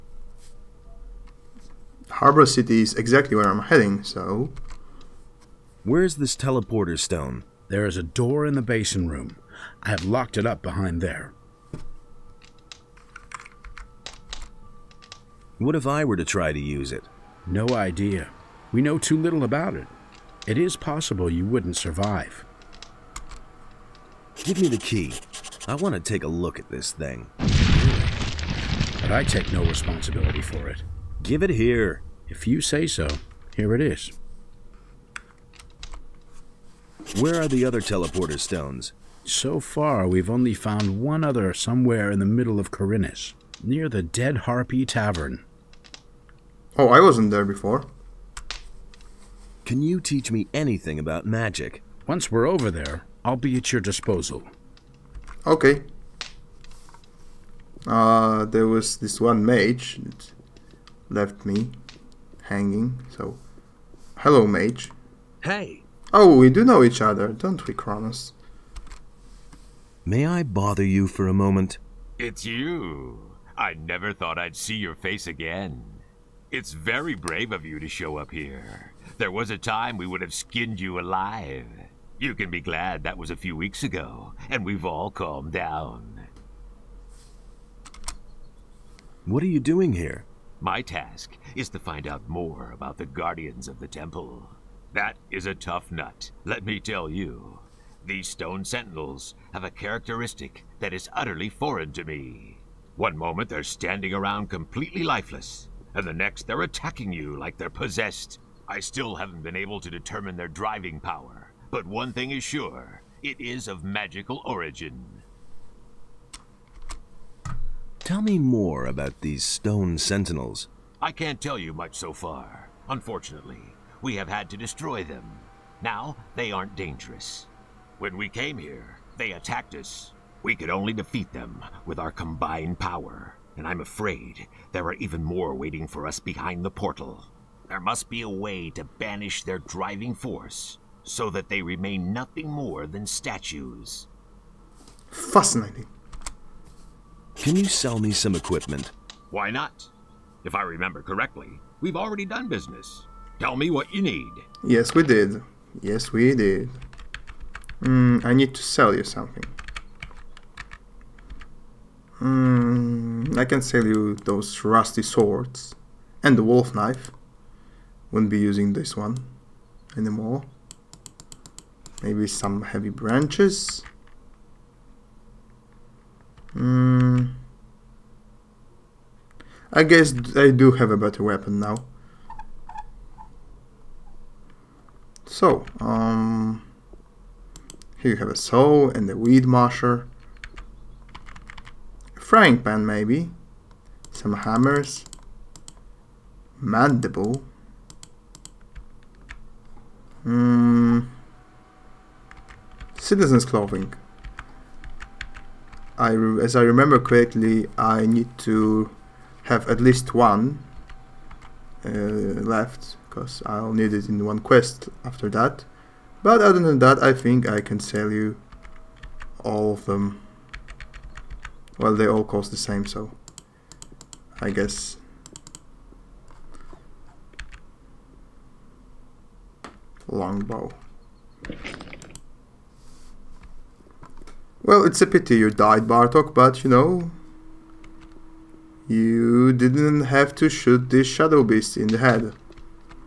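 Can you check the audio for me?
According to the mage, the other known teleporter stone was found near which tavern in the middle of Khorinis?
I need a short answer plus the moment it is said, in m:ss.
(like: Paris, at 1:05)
Dead Harpy Tavern, at 0:44.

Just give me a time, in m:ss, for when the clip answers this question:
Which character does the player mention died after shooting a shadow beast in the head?
3:55.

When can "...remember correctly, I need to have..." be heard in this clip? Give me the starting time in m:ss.
3:26.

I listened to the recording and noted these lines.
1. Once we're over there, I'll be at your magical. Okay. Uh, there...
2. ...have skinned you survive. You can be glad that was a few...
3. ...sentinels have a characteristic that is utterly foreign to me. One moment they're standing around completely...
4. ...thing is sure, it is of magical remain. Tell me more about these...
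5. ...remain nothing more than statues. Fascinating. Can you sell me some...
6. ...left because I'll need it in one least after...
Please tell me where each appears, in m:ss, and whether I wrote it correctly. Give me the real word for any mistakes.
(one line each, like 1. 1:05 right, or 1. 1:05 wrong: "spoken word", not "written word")
1. 0:52 wrong: "disposal", not "magical"
2. 1:20 wrong: "alive", not "survive"
3. 1:38 right
4. 1:52 wrong: "origin", not "remain"
5. 2:21 right
6. 3:32 wrong: "quest", not "least".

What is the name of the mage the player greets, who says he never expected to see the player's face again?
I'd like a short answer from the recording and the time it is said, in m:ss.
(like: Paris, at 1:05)
Cronos, at 1:07.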